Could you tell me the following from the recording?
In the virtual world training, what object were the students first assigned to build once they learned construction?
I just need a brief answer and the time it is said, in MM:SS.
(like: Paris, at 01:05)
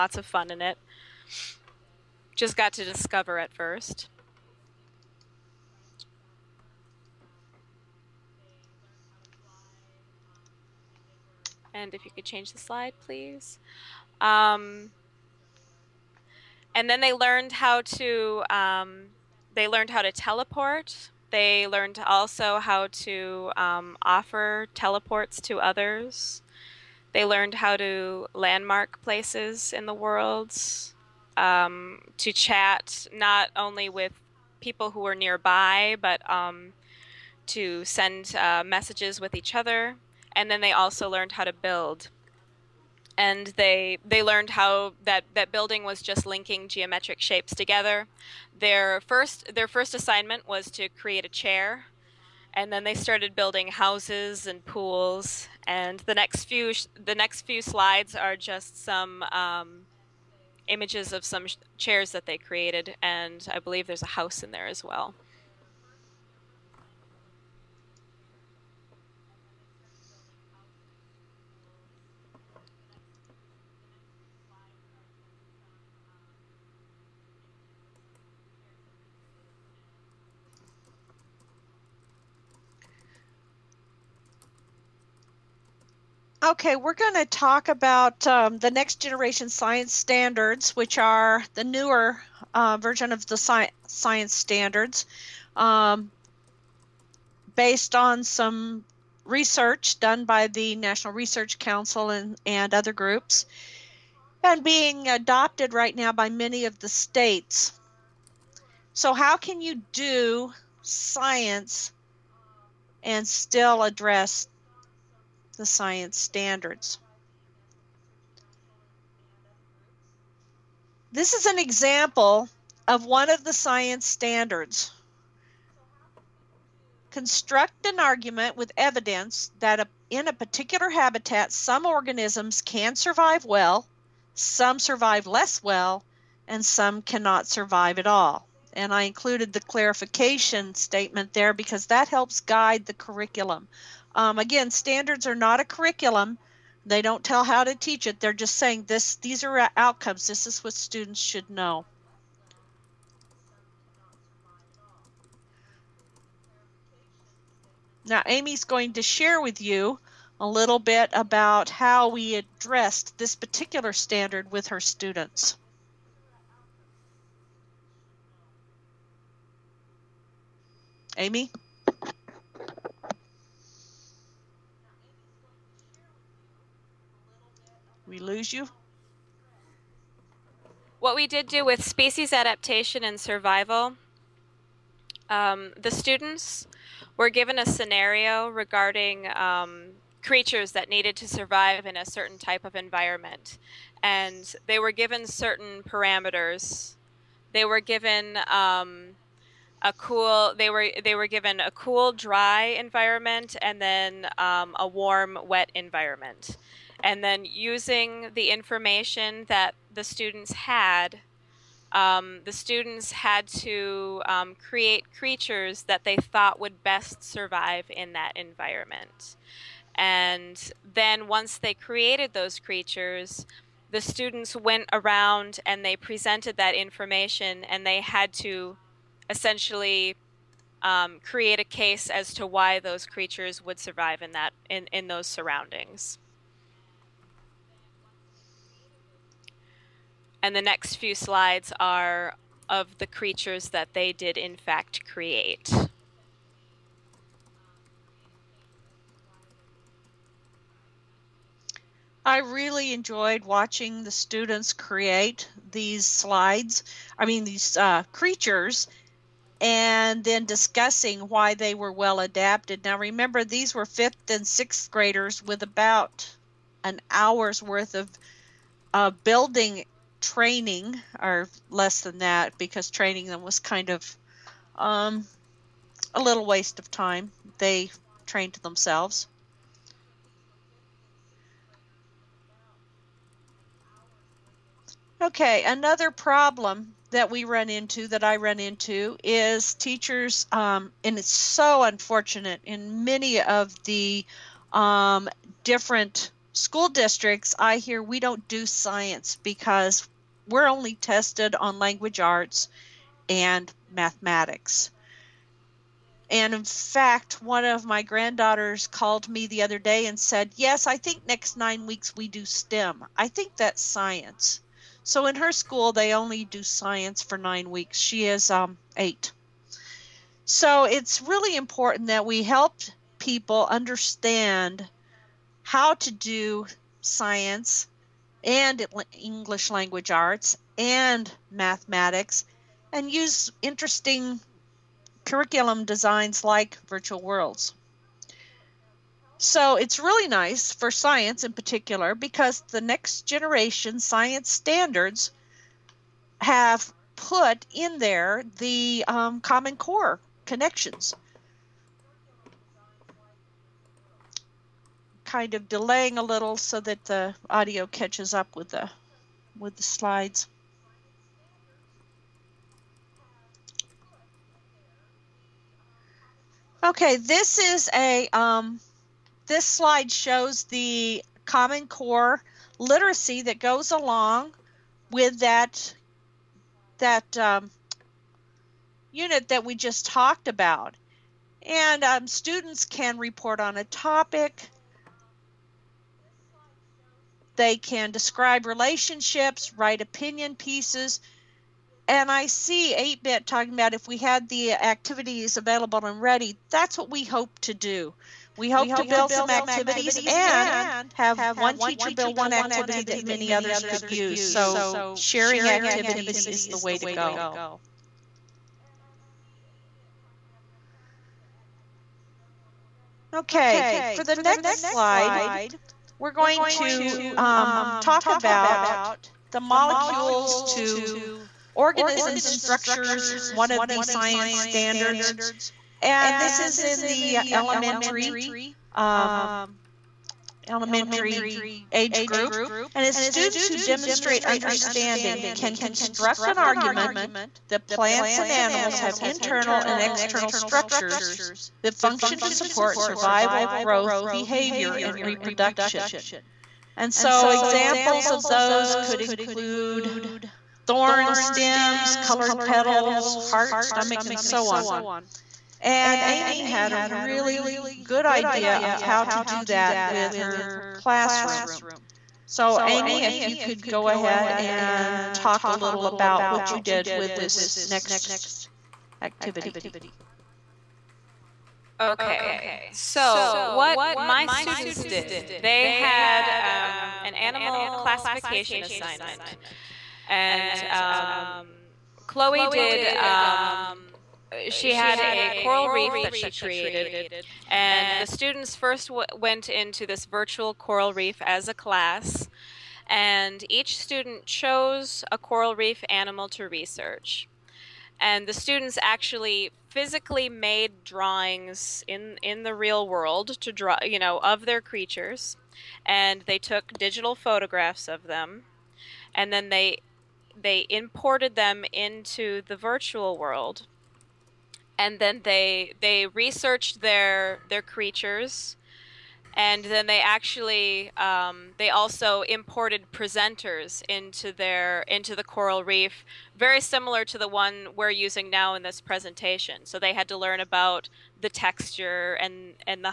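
A chair, at 00:51.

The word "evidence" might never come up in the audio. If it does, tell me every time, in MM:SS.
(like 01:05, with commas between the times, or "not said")
02:08.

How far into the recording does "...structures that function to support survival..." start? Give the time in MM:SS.
07:20.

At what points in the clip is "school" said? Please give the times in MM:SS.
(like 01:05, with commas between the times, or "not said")
04:56, 05:15.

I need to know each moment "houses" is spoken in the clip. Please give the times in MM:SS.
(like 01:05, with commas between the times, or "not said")
00:53, 01:04.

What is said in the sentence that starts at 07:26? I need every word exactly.
And so, examples of those could include thorn stems, colored petals, heart, stomach, and so on.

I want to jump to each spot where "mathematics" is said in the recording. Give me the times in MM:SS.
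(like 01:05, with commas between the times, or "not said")
05:03, 05:31.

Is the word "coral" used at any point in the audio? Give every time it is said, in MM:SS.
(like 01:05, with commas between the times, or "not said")
08:05, 08:10, 08:15, 08:45.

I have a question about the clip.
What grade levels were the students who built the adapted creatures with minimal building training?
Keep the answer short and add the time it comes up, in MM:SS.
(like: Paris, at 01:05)
Fifth and sixth graders, at 04:23.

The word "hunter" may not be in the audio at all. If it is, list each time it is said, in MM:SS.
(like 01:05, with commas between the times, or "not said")
not said.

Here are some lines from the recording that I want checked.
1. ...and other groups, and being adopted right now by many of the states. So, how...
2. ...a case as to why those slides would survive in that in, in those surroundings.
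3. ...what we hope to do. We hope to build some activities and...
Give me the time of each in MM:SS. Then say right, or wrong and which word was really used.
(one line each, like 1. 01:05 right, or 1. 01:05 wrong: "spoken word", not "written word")
1. 01:42 right
2. 03:51 wrong: "creatures", not "slides"
3. 06:36 right.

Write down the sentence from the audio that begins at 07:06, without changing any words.
And this is in the elementary um, elementary age group.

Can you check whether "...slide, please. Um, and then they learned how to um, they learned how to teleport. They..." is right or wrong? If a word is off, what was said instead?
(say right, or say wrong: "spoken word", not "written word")
right.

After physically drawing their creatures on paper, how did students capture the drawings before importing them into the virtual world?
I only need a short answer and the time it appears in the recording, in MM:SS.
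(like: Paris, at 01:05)
Digital photographs, at 08:26.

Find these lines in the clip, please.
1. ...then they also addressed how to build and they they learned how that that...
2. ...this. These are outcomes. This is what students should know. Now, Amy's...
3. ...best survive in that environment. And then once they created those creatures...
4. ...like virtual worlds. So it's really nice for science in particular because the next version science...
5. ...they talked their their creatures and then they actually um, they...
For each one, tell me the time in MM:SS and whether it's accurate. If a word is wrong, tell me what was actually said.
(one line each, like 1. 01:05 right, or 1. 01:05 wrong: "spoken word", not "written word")
1. 00:40 wrong: "learned", not "addressed"
2. 02:28 right
3. 03:36 right
4. 05:36 wrong: "generation", not "version"
5. 08:36 wrong: "researched", not "talked".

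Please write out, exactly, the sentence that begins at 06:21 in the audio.
And um, students can report on a topic.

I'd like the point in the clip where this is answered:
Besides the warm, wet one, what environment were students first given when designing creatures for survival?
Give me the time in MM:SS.
03:21.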